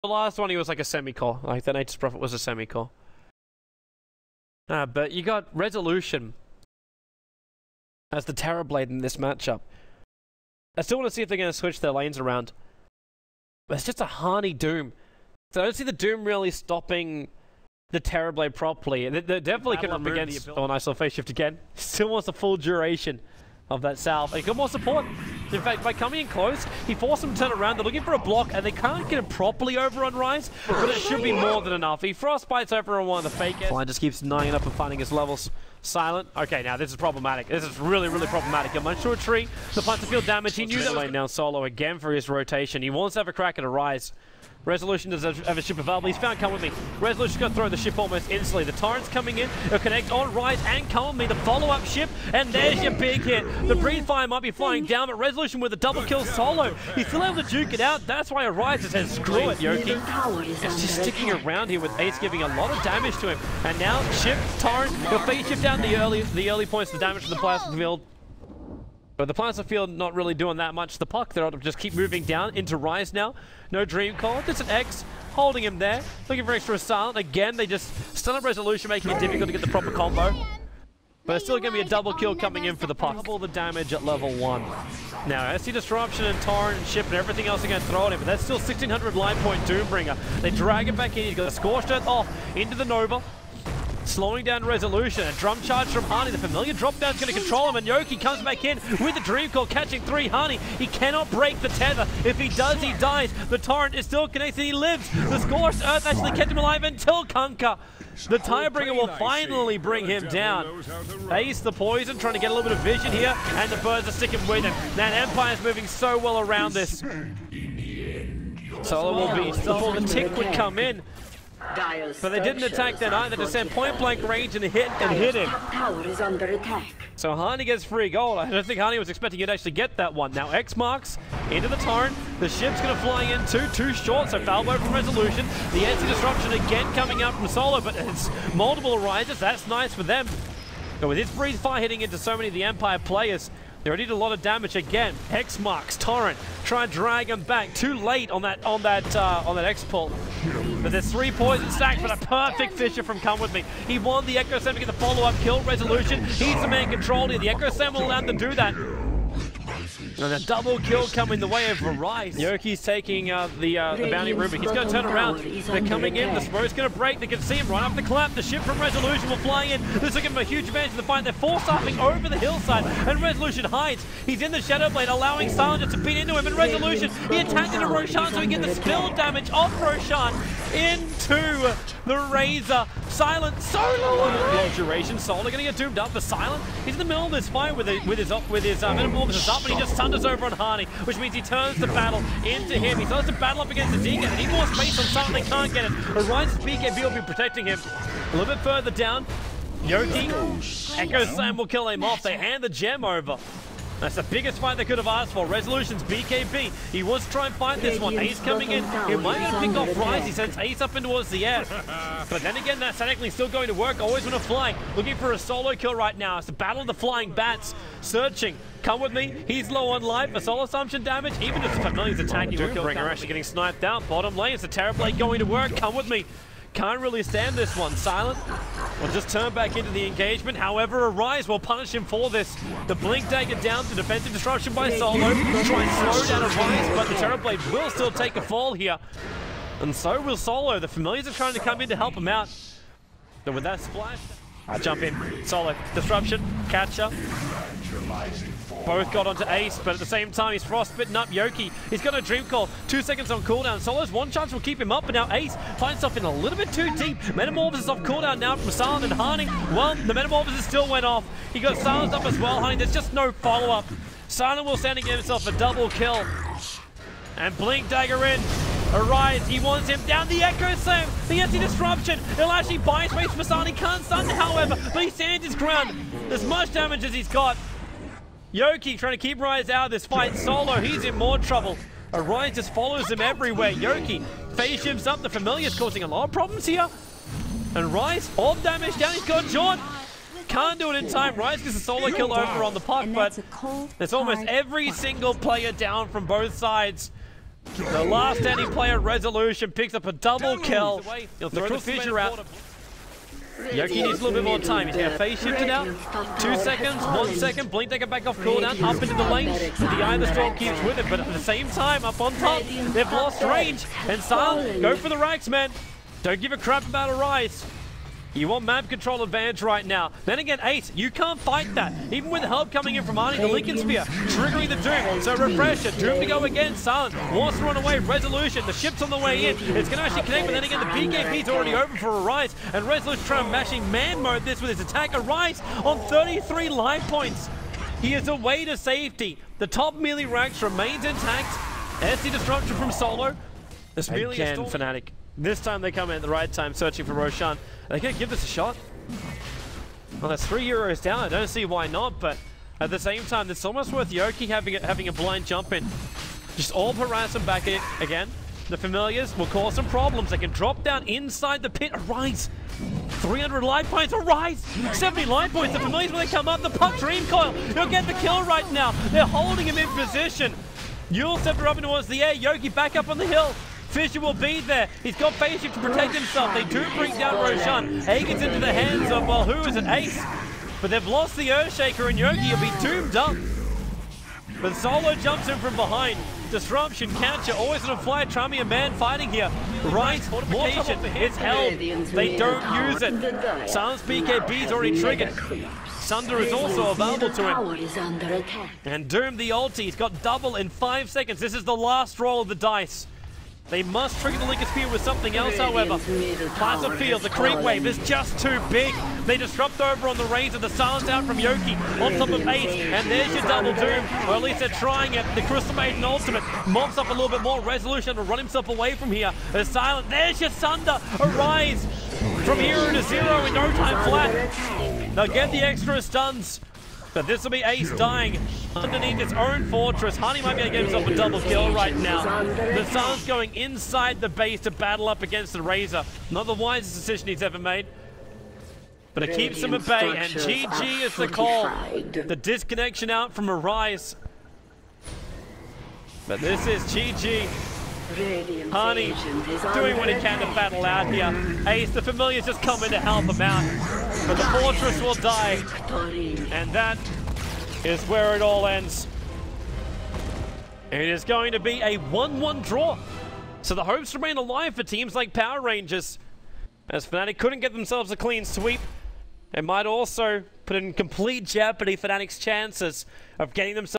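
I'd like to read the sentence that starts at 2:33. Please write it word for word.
He won the Echo Slam to get the follow-up kill resolution.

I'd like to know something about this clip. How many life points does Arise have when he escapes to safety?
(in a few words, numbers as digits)
33.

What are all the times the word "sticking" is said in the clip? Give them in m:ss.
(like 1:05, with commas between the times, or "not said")
1:01, 1:54.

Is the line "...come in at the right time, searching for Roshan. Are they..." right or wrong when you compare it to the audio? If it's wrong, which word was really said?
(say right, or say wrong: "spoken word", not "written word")
right.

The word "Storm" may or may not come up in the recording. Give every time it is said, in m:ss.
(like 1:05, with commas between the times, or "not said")
5:10.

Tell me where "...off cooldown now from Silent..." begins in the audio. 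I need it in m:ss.
4:17.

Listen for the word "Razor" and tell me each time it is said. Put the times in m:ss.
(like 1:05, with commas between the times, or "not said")
3:02, 7:15.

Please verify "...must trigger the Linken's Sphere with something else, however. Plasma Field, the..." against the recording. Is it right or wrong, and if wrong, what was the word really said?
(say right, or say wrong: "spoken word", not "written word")
right.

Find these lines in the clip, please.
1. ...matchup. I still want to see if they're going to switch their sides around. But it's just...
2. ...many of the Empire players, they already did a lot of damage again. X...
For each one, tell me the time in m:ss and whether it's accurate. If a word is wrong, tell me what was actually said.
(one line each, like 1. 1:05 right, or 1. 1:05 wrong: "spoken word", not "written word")
1. 0:09 wrong: "lanes", not "sides"
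2. 2:22 right.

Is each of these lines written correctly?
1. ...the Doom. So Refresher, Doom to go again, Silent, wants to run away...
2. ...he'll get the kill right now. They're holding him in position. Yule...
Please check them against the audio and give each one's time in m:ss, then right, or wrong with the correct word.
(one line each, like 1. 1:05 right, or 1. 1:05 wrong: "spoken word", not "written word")
1. 5:24 right
2. 6:07 right.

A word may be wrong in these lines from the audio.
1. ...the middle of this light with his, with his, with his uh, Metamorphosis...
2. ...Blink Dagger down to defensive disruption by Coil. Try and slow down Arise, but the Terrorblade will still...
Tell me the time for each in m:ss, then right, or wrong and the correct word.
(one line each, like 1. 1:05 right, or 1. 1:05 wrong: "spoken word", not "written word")
1. 3:06 wrong: "fight", not "light"
2. 3:52 wrong: "Solo", not "Coil".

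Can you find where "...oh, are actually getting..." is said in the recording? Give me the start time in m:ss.
3:42.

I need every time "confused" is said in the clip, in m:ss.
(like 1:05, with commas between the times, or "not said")
not said.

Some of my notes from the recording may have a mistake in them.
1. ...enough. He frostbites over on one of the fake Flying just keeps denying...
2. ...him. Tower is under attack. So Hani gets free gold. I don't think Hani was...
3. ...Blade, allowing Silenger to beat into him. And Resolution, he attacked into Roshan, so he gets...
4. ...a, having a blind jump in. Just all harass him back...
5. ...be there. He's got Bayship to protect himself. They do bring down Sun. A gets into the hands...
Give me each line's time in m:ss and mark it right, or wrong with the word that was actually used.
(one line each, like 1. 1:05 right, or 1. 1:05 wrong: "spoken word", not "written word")
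1. 0:31 right
2. 2:05 right
3. 2:54 right
4. 5:54 right
5. 6:14 wrong: "Roshan", not "Sun".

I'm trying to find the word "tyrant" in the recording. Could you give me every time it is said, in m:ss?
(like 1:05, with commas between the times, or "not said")
0:48, 1:04.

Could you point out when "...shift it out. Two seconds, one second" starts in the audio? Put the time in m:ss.
5:05.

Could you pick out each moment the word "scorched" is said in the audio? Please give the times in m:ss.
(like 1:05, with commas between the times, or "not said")
1:31, 1:45.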